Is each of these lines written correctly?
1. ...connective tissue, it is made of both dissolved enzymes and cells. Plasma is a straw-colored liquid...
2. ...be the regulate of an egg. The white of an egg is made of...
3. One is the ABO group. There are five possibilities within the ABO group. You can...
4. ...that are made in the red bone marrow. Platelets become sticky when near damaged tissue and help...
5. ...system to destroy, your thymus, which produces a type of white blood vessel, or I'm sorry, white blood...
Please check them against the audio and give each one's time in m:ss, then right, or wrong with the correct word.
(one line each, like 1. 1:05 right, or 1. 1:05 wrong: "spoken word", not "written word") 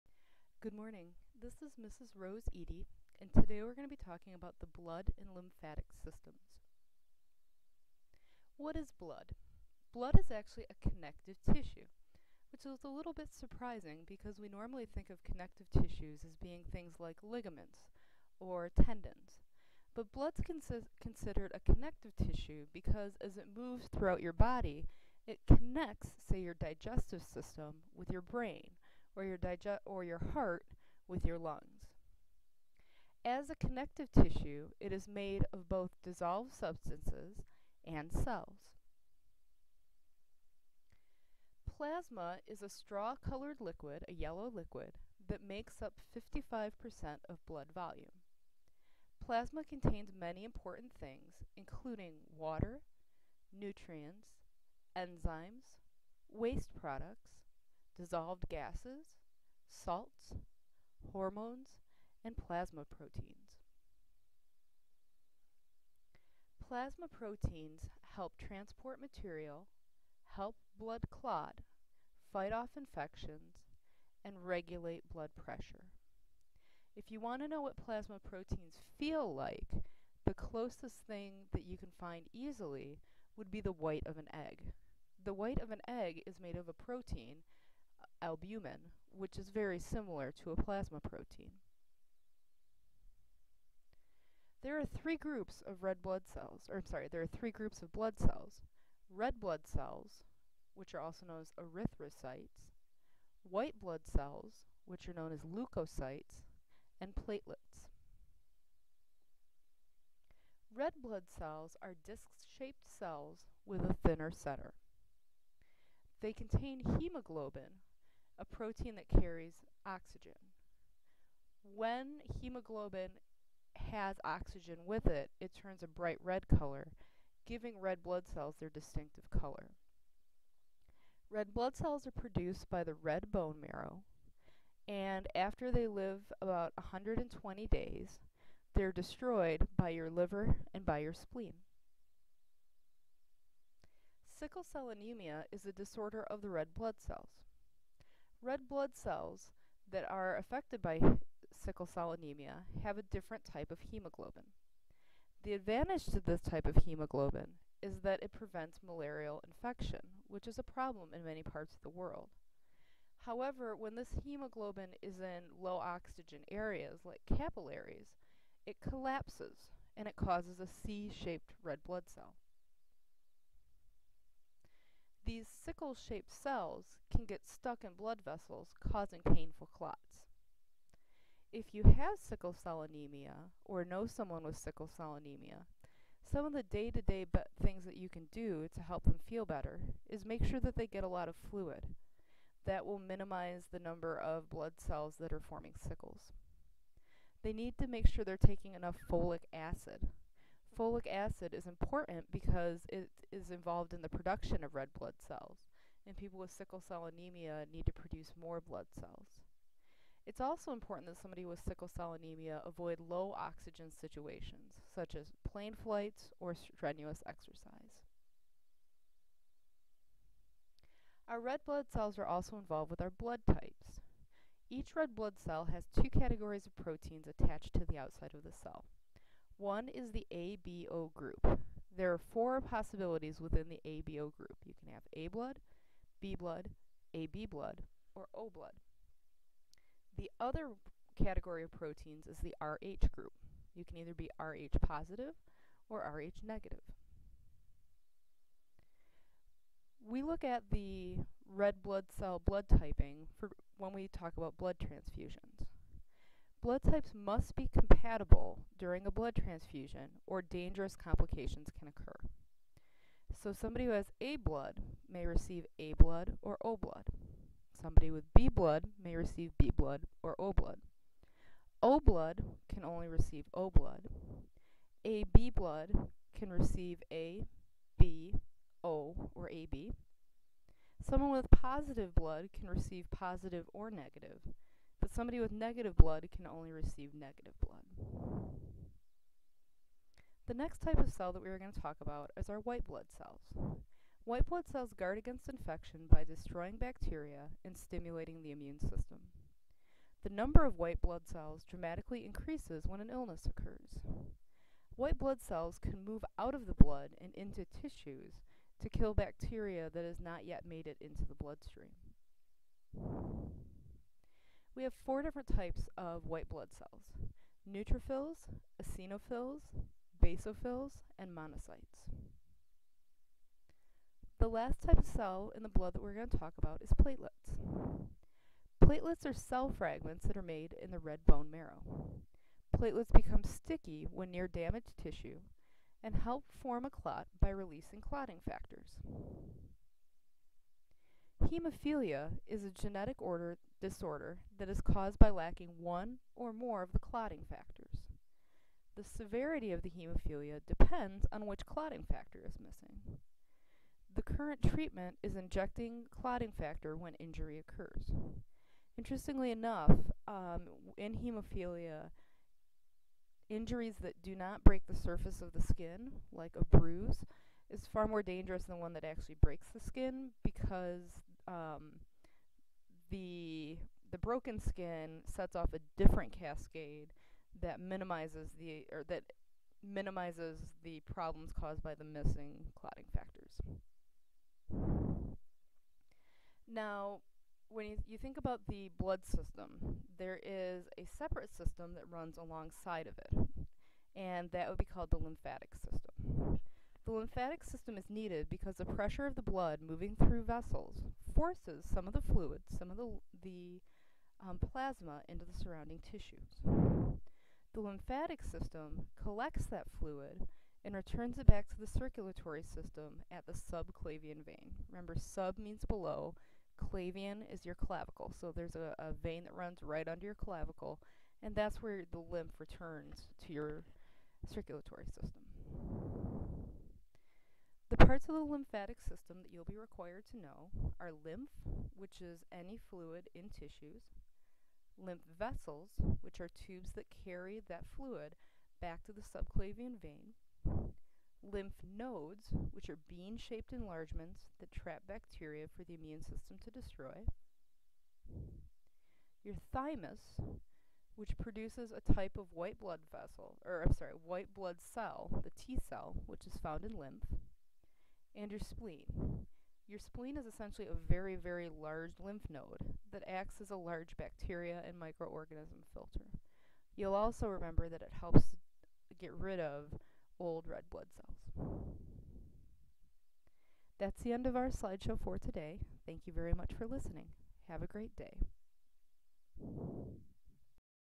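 1. 0:33 wrong: "substances", not "enzymes"
2. 1:23 wrong: "white", not "regulate"
3. 3:49 wrong: "four", not "five"
4. 5:30 right
5. 7:26 right.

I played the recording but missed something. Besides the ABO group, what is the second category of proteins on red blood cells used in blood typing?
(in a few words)
RH group.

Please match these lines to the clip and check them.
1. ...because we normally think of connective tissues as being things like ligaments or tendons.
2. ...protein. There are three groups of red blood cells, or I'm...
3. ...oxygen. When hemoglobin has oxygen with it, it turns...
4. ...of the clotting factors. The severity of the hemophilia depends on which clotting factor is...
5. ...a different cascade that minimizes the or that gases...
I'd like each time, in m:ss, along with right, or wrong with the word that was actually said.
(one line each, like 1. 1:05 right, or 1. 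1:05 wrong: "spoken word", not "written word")
1. 0:14 right
2. 1:30 right
3. 1:59 right
4. 5:46 right
5. 6:15 wrong: "minimizes", not "gases".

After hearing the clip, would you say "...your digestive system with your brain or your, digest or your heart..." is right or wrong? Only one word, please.
right.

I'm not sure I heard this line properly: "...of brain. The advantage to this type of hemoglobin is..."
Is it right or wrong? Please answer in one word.
wrong.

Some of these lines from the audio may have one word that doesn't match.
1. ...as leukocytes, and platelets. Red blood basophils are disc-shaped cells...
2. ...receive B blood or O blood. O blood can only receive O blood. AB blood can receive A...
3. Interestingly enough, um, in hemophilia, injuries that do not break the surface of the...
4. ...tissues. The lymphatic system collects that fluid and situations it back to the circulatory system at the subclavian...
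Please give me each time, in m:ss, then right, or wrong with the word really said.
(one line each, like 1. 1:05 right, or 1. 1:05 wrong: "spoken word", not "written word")
1. 1:45 wrong: "cells", not "basophils"
2. 4:29 right
3. 5:58 right
4. 6:45 wrong: "returns", not "situations".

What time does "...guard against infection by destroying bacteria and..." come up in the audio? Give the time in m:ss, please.
4:54.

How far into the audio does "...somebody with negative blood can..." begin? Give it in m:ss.
4:45.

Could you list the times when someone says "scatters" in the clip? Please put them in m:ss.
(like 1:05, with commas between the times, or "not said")
not said.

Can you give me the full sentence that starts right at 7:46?
You'll also remember that it helps get rid of old red blood cells.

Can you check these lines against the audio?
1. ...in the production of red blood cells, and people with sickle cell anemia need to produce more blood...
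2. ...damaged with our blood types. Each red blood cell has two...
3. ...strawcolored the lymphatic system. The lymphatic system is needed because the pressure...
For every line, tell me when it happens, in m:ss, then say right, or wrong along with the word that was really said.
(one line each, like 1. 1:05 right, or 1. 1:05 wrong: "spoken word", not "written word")
1. 3:23 right
2. 3:42 wrong: "involved", not "damaged"
3. 6:34 wrong: "called", not "strawcolored".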